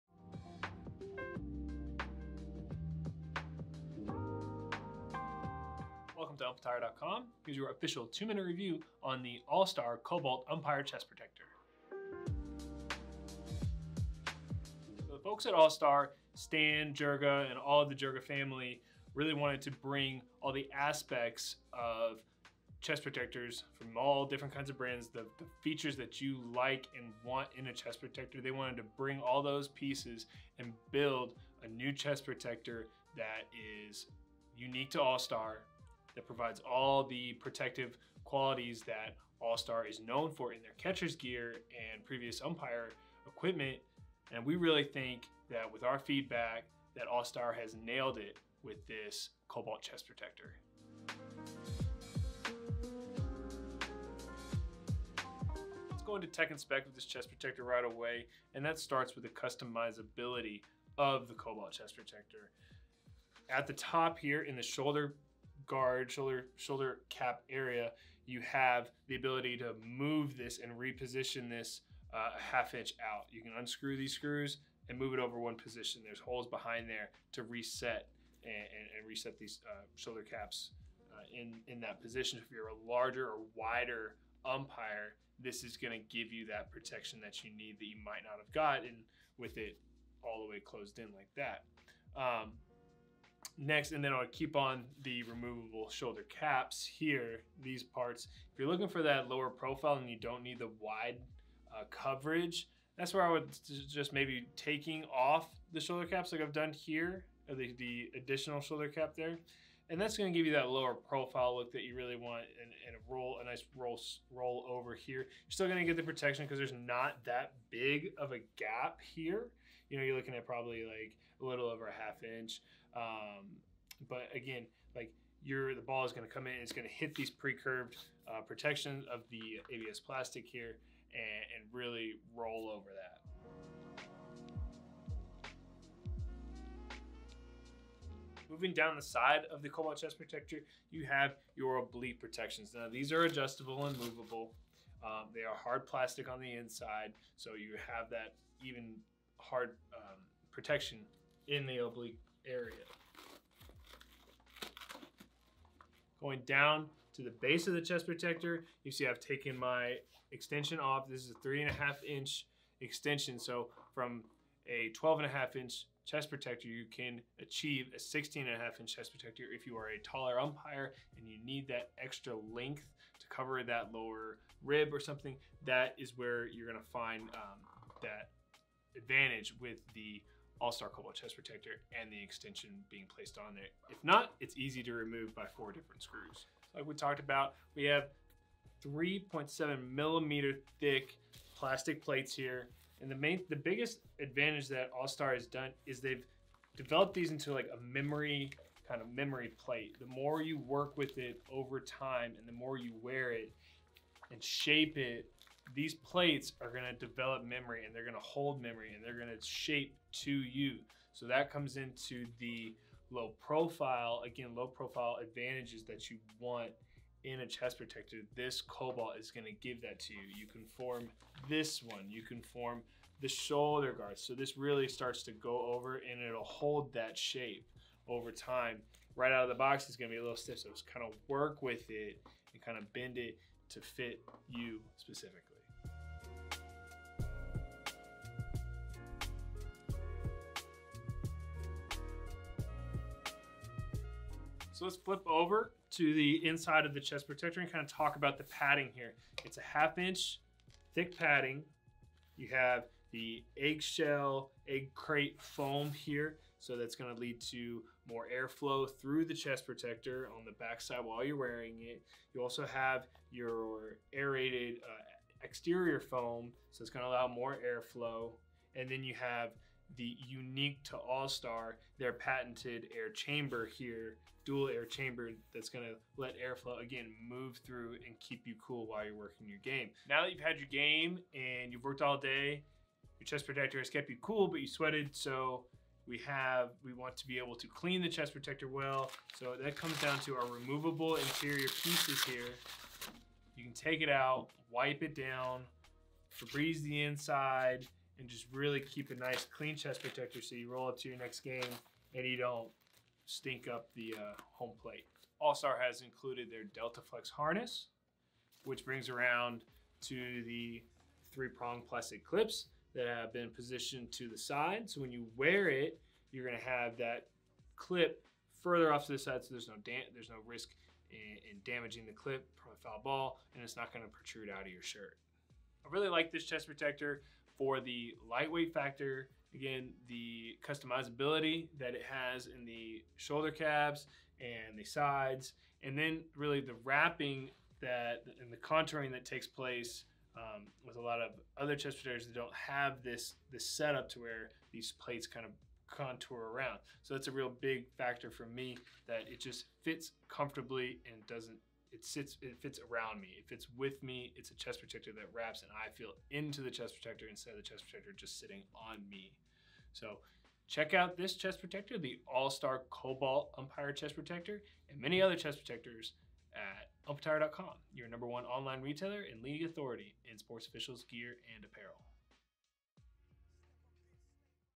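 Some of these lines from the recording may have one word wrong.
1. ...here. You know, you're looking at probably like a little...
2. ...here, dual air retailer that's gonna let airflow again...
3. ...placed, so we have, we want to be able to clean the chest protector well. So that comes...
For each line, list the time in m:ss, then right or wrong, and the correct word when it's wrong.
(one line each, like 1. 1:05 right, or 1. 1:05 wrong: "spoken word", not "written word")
1. 1:59 right
2. 4:33 wrong: "chamber", not "retailer"
3. 4:44 wrong: "sweated", not "placed".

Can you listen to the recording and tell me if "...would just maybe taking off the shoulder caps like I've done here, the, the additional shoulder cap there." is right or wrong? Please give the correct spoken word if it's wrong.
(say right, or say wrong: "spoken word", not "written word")
right.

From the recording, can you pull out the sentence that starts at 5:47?
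So that's a real big factor for me that it just fits comfortably and doesn't, it sits, it fits around me.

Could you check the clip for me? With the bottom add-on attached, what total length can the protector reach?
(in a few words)
16.5 inches.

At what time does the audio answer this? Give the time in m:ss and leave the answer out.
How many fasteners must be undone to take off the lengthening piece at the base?
3:05.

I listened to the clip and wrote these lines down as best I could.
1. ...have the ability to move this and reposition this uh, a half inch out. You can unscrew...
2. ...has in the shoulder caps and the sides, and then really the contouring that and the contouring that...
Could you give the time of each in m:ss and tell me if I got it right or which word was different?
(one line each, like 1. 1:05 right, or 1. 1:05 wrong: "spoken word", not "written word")
1. 1:08 right
2. 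5:32 wrong: "wrapping", not "contouring".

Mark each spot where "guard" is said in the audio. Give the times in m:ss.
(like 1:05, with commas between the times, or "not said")
1:05, 3:43.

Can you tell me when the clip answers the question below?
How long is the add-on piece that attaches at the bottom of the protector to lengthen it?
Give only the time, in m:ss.
2:41.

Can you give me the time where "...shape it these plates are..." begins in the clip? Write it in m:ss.
3:24.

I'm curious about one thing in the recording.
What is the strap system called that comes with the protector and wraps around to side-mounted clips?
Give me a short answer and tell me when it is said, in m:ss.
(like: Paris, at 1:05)
Delta Flex harness, at 5:06.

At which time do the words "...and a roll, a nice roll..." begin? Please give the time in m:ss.
1:52.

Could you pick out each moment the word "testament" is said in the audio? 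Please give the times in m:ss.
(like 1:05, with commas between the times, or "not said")
not said.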